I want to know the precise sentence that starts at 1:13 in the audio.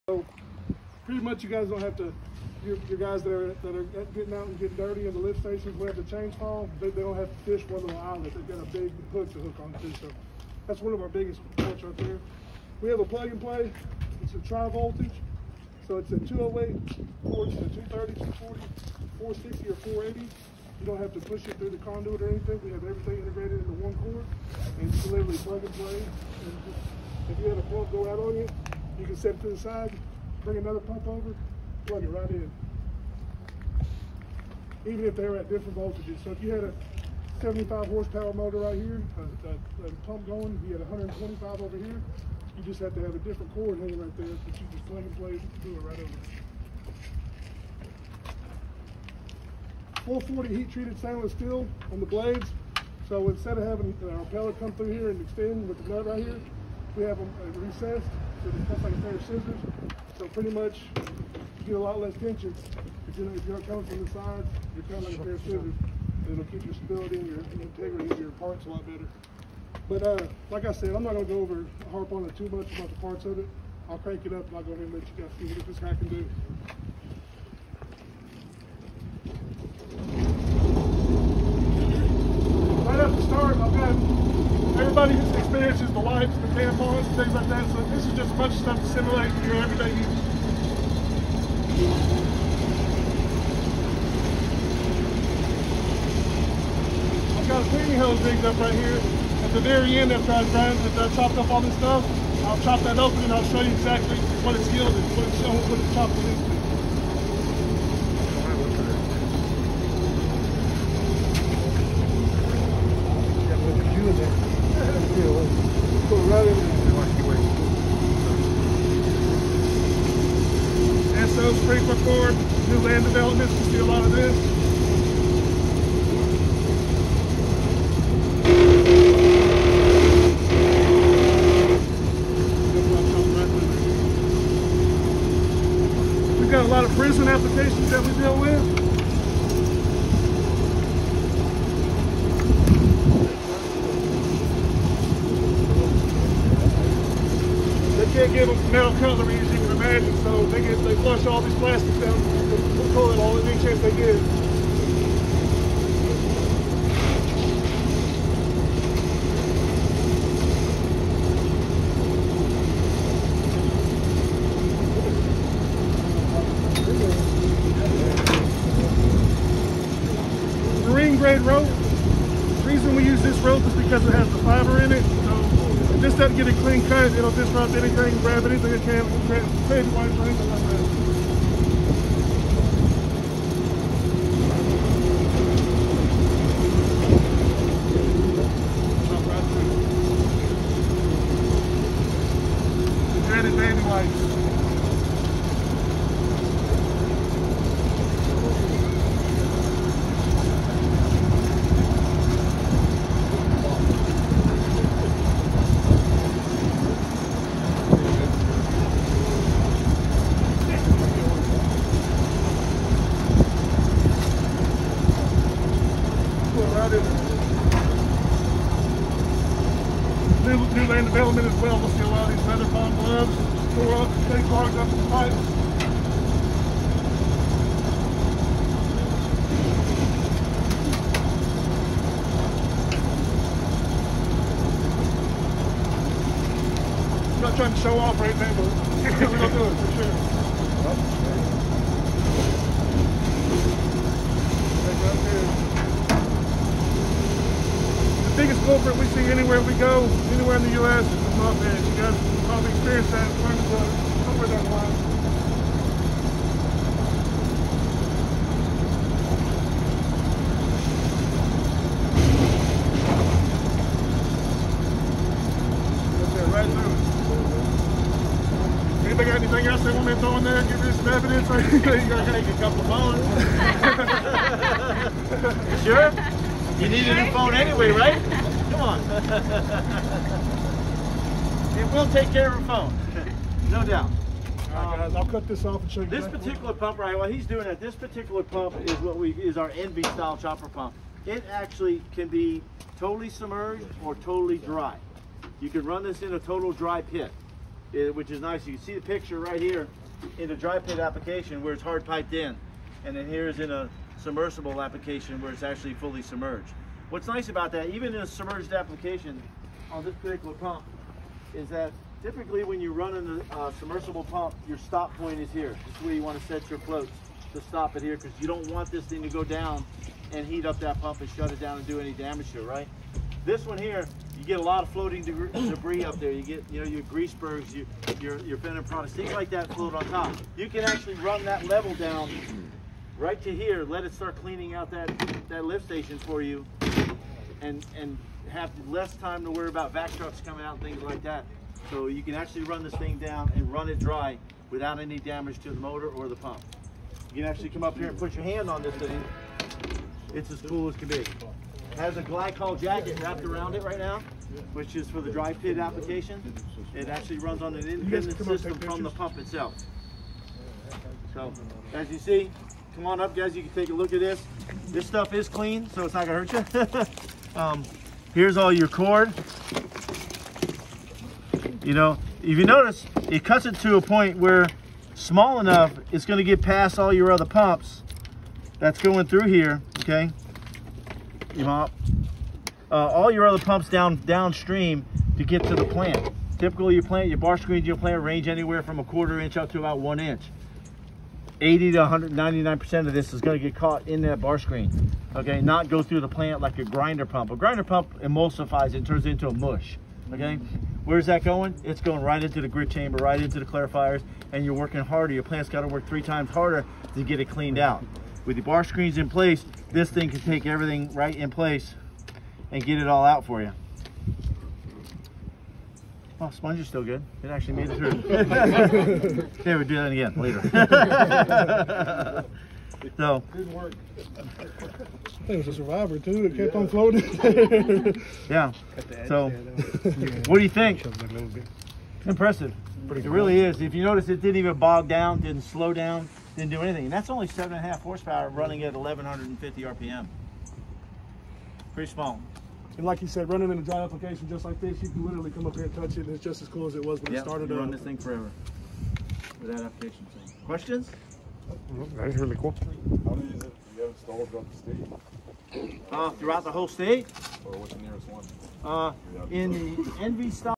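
I'll crank it up and I'll go ahead and let you guys see what this guy can do.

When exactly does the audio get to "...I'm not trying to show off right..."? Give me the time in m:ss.
3:57.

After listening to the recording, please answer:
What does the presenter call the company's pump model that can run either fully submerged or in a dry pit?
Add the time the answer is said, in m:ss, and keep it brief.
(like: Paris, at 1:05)
NV style chopper pump, at 4:49.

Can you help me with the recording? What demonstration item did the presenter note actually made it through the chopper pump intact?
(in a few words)
Sponge.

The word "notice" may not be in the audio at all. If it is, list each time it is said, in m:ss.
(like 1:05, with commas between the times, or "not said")
6:12, 7:14.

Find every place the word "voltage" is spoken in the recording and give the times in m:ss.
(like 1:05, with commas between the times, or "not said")
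0:14, 0:35.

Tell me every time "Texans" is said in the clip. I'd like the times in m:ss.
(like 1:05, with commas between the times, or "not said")
not said.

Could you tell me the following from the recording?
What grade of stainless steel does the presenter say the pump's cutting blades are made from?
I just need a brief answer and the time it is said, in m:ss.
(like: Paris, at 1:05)
440 heat treated stainless steel, at 0:50.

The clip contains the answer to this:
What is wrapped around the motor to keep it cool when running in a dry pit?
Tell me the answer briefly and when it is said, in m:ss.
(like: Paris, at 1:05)
A glycol jacket, at 5:52.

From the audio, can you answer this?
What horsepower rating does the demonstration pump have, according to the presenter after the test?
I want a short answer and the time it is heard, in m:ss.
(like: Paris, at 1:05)
7.5 horsepower, at 7:17.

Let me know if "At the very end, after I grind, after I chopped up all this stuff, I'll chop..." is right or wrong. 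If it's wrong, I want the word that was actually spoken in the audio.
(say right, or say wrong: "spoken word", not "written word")
right.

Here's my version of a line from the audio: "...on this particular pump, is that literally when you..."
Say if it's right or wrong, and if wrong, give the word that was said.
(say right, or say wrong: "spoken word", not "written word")
wrong: "typically", not "literally".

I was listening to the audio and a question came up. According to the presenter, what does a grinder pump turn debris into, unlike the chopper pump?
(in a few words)
Mush.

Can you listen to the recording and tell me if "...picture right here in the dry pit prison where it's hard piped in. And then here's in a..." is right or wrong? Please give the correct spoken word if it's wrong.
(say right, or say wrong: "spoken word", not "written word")
wrong: "application", not "prison".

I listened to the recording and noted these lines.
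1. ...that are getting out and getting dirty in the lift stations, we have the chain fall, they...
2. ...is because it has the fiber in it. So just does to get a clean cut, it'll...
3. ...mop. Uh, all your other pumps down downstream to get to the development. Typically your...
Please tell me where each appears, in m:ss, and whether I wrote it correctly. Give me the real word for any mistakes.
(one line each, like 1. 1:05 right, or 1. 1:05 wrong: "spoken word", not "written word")
1. 0:03 right
2. 2:53 right
3. 6:21 wrong: "plant", not "development".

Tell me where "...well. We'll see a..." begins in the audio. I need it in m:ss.
3:41.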